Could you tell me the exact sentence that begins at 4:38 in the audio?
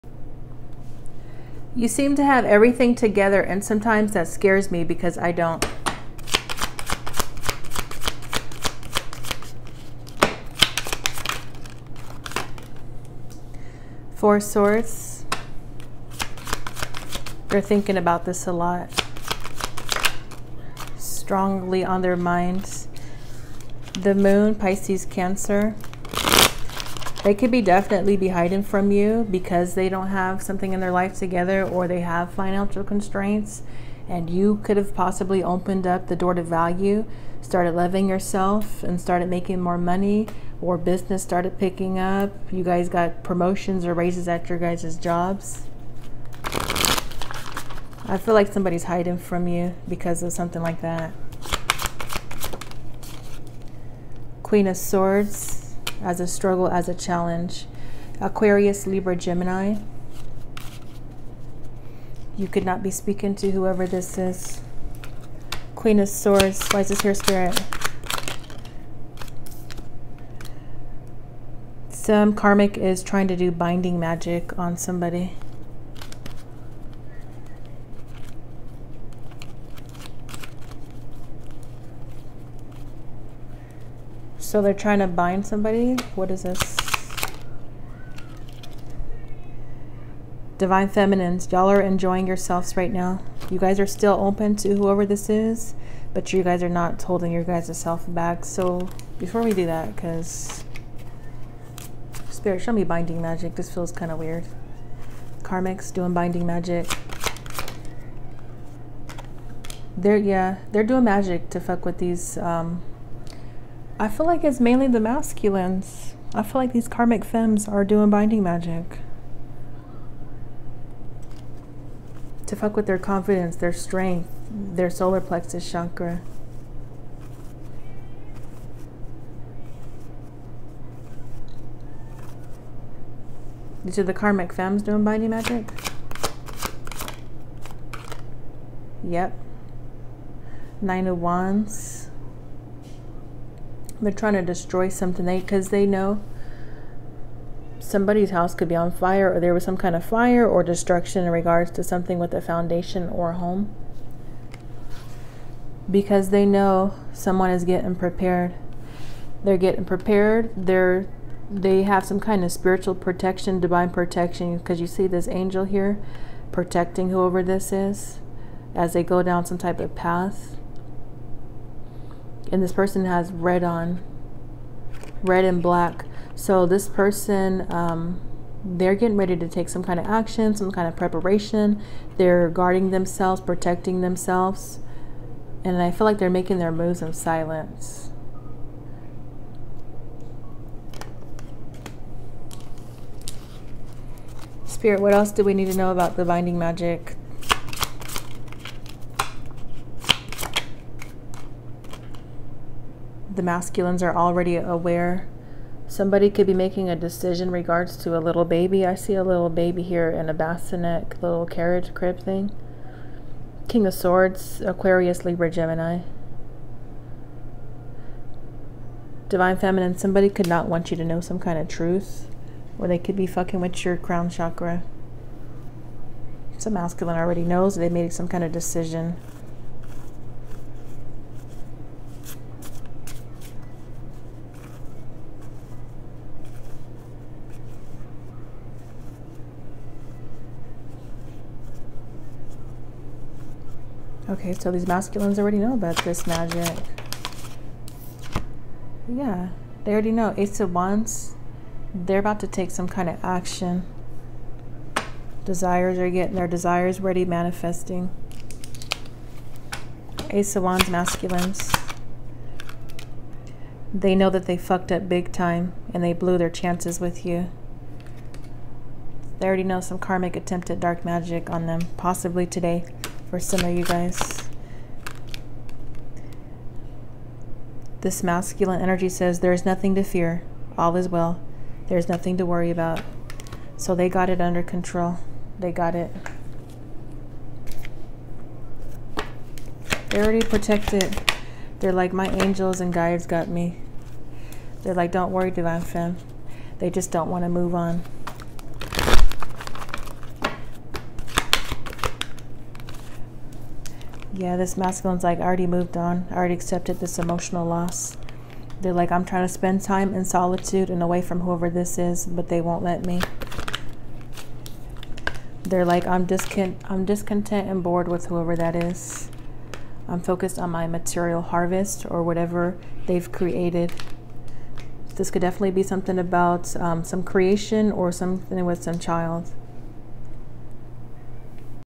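This masculine energy says there is nothing to fear.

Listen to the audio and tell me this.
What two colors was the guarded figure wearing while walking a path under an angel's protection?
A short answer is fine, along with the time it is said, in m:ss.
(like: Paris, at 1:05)
Red and black, at 2:55.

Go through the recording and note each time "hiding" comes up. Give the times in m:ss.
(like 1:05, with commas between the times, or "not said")
0:28, 0:48.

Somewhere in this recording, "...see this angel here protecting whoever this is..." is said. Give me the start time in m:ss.
2:44.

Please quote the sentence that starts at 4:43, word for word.
So they got it under control.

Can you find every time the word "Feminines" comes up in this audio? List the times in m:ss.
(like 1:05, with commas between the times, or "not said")
1:30, 3:39.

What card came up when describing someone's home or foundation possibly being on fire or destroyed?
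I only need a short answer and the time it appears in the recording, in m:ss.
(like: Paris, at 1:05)
Nine of Wands, at 2:20.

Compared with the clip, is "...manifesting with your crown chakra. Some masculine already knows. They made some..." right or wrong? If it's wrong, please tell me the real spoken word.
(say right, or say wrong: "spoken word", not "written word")
wrong: "fucking", not "manifesting".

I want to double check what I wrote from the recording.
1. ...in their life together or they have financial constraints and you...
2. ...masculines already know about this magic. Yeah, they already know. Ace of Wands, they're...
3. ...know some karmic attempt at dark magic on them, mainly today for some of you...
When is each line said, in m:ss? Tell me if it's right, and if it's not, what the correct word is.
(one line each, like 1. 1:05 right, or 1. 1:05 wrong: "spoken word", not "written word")
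1. 0:30 right
2. 4:04 right
3. 4:29 wrong: "possibly", not "mainly".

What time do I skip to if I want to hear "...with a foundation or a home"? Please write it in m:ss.
2:32.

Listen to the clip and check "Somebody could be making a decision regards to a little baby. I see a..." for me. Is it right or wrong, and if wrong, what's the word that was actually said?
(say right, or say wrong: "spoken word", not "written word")
right.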